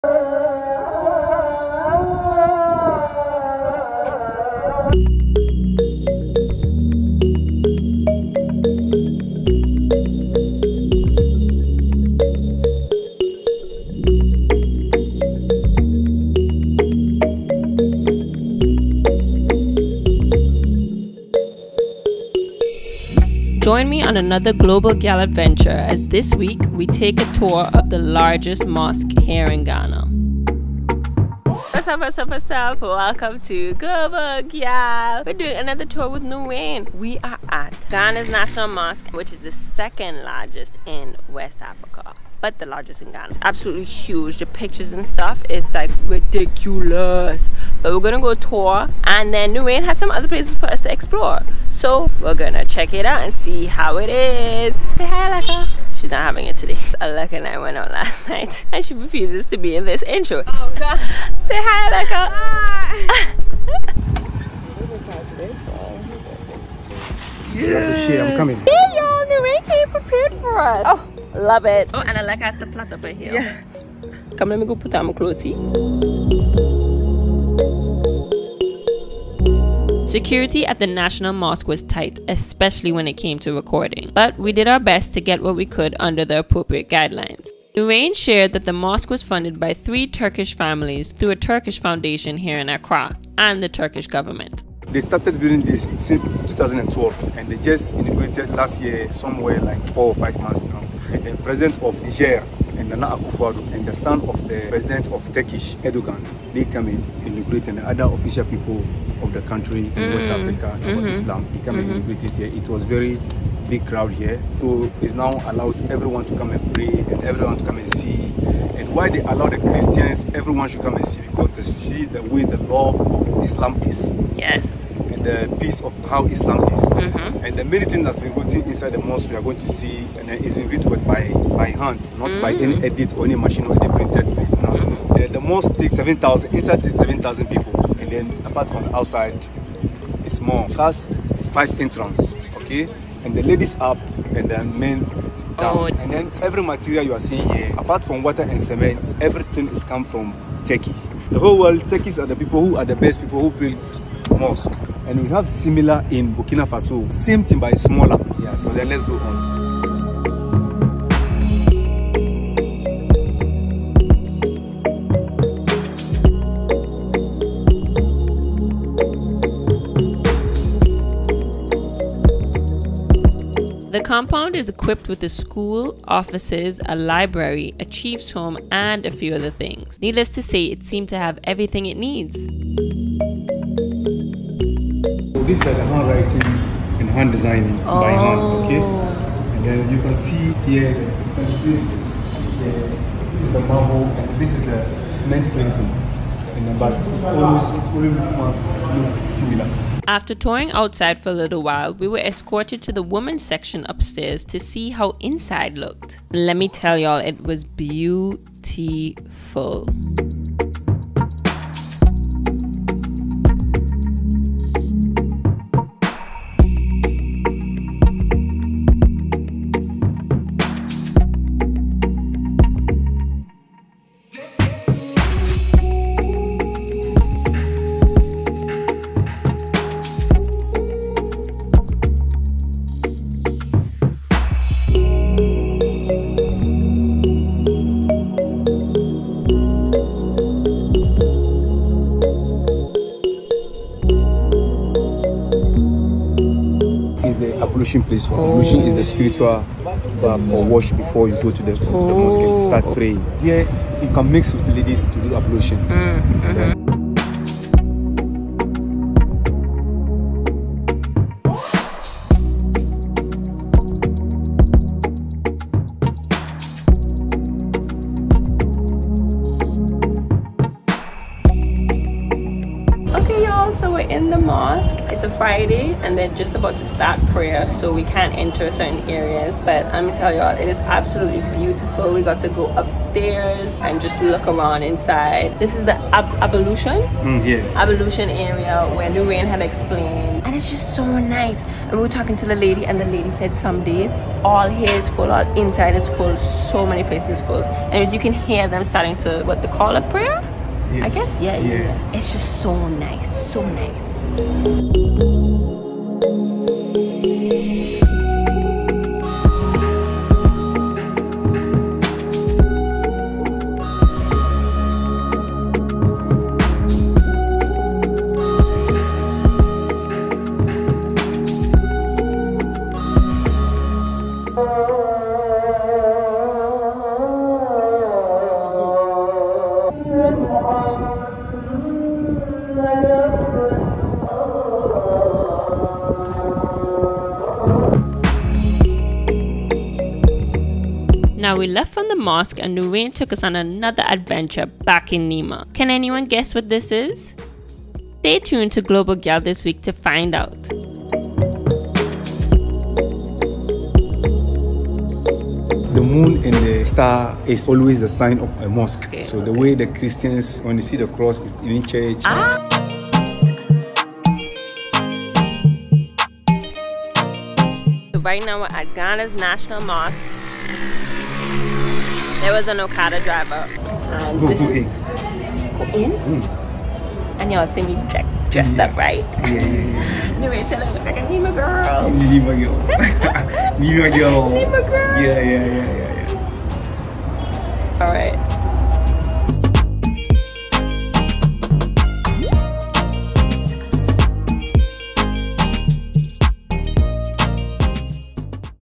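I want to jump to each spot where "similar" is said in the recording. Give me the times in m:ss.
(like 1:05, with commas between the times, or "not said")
2:35, 3:19.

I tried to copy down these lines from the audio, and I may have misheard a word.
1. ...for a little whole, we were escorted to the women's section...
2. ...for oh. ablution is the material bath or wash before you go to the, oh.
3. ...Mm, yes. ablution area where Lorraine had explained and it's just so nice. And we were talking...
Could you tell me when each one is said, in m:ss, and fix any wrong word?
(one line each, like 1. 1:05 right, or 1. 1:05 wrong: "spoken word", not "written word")
1. 3:21 wrong: "while", not "whole"
2. 4:08 wrong: "spiritual", not "material"
3. 4:46 right.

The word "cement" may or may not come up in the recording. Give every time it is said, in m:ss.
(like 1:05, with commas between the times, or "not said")
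2:28, 3:15.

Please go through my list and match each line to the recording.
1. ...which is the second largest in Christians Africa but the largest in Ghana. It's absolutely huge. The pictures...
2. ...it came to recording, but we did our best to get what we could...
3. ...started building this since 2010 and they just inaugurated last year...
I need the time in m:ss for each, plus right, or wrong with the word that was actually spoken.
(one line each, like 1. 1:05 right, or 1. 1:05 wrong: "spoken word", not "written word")
1. 0:39 wrong: "West", not "Christians"
2. 1:23 right
3. 1:35 wrong: "2012", not "2010".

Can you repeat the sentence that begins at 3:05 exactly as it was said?
So these are the handwriting and hand designing oh.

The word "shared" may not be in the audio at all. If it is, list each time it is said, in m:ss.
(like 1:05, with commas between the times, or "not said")
1:28.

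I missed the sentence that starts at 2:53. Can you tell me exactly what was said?
The compound is equipped with a school, offices, a library, a chief's home, and a few other things.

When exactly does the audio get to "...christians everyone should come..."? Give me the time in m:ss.
1:59.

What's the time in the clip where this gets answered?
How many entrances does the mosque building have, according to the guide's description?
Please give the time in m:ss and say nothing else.
2:21.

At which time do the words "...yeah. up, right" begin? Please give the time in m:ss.
6:18.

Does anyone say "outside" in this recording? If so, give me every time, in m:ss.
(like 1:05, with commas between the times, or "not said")
2:18, 3:20.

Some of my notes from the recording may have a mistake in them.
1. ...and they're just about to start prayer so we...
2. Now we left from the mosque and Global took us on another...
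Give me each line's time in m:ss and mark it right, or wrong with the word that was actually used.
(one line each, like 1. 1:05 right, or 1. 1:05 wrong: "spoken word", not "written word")
1. 4:36 right
2. 5:41 wrong: "Nurainy", not "Global".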